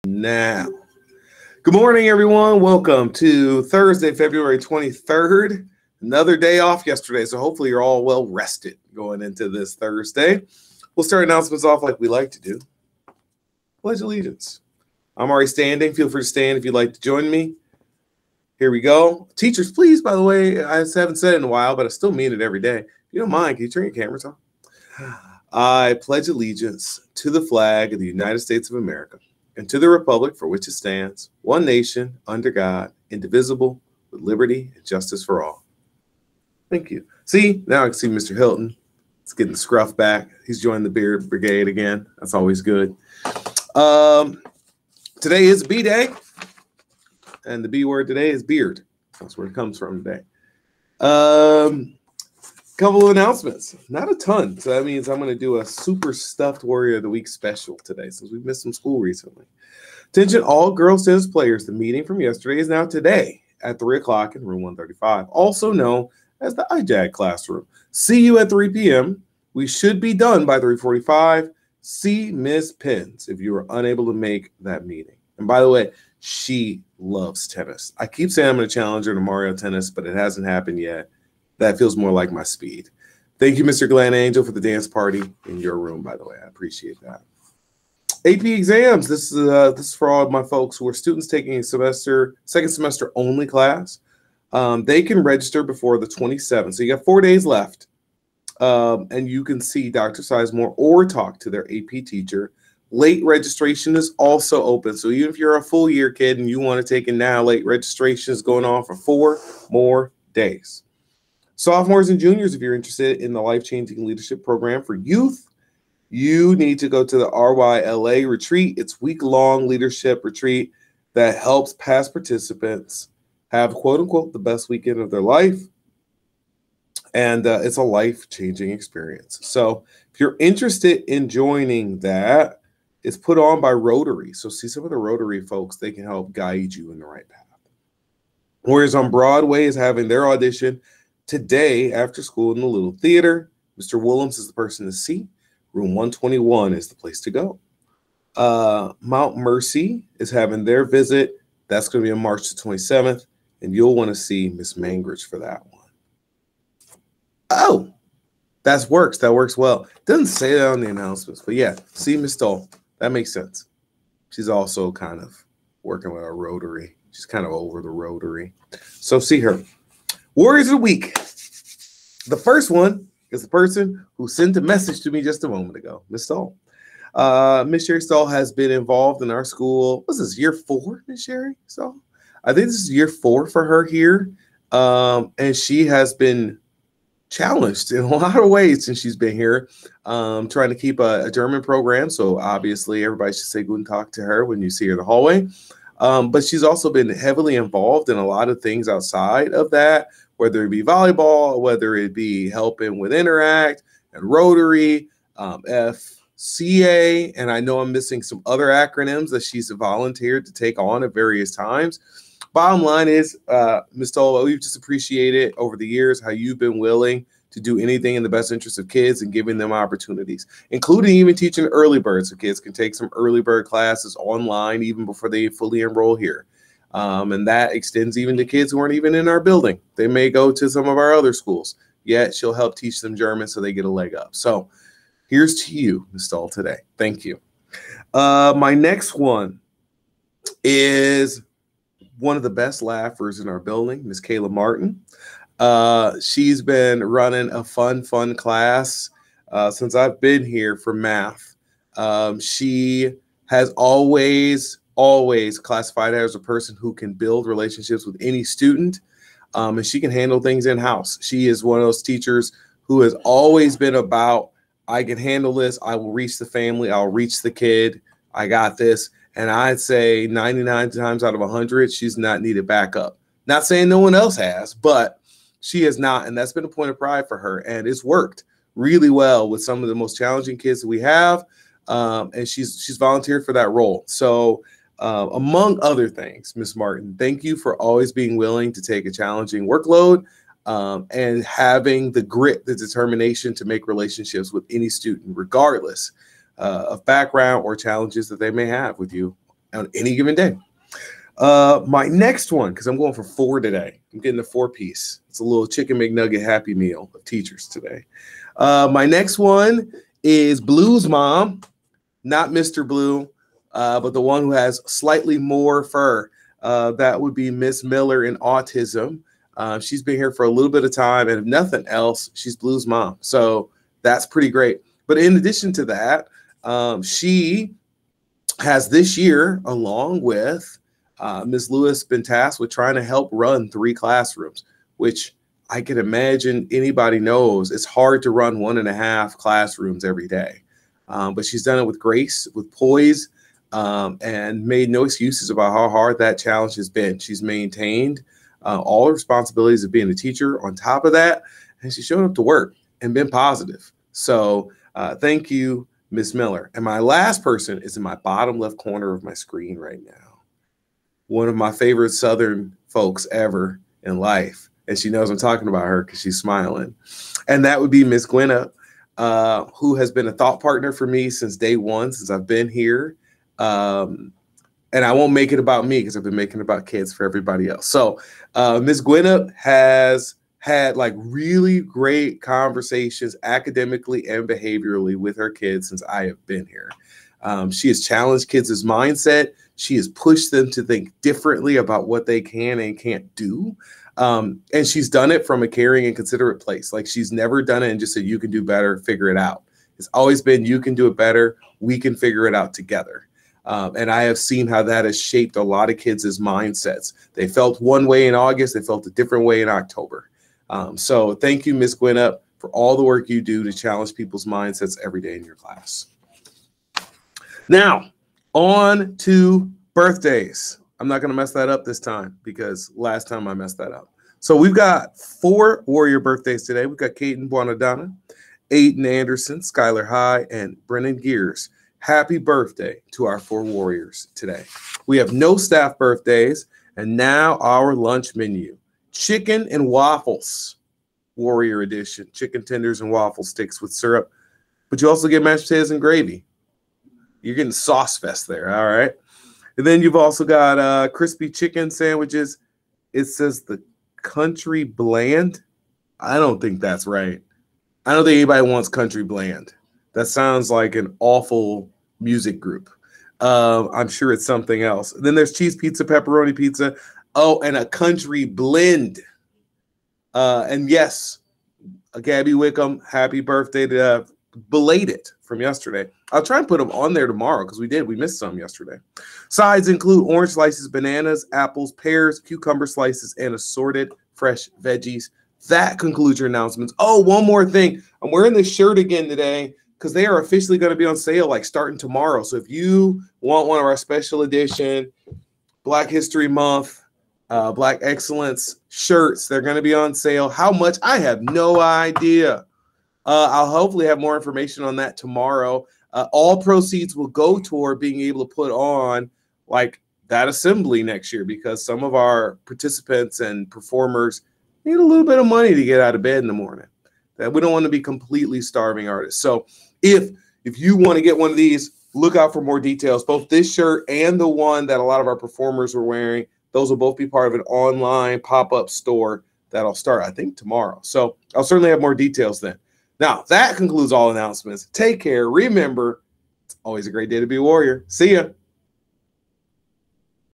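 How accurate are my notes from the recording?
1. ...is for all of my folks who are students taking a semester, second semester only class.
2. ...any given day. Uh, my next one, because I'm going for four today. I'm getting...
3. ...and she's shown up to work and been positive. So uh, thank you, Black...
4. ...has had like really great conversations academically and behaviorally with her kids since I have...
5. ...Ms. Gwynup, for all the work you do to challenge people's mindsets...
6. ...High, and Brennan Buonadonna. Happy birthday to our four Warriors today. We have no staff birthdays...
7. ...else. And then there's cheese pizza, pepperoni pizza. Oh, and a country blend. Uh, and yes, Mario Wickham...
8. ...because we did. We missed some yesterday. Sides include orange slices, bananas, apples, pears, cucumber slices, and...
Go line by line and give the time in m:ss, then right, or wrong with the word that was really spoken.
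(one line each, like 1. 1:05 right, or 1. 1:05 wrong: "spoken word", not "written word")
1. 1:29 right
2. 4:59 right
3. 5:51 wrong: "Miss", not "Black"
4. 6:19 right
5. 6:51 right
6. 7:10 wrong: "Gears", not "Buonadonna"
7. 7:44 wrong: "Gabby", not "Mario"
8. 7:57 right.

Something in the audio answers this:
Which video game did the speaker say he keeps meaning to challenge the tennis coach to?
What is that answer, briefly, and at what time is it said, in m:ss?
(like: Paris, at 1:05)
Mario Tennis, at 1:19.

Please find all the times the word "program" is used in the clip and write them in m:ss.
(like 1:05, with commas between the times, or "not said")
1:54, 3:11.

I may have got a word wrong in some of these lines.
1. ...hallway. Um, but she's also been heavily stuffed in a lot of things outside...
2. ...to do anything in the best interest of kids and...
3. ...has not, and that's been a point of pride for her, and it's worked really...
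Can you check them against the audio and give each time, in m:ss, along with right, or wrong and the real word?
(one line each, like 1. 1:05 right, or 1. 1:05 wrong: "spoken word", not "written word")
1. 3:15 wrong: "involved", not "stuffed"
2. 3:37 right
3. 4:35 right.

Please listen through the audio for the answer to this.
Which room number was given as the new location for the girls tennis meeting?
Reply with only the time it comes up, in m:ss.
1:04.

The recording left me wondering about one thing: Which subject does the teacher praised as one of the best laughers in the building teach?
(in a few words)
math.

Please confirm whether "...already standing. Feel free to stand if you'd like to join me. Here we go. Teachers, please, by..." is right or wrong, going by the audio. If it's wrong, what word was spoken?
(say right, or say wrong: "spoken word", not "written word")
right.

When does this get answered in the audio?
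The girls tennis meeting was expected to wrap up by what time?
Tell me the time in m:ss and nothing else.
1:10.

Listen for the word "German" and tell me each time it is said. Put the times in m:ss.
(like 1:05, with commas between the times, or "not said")
3:11, 3:53.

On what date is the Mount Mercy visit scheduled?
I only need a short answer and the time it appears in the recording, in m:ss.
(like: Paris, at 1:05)
March 27, at 2:32.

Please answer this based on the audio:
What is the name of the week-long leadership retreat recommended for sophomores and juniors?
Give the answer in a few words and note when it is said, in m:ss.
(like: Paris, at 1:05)
RYLA, at 1:57.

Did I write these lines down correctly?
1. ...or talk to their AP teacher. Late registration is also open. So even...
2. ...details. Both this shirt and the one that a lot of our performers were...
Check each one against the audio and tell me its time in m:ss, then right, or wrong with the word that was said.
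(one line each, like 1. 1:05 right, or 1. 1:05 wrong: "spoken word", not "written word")
1. 1:40 right
2. 8:42 right.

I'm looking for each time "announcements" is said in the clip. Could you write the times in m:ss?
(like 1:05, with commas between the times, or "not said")
0:11, 0:53, 2:40, 8:06, 8:54.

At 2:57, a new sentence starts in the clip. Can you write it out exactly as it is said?
Uh, Miss Sherry Saul has been involved in our school.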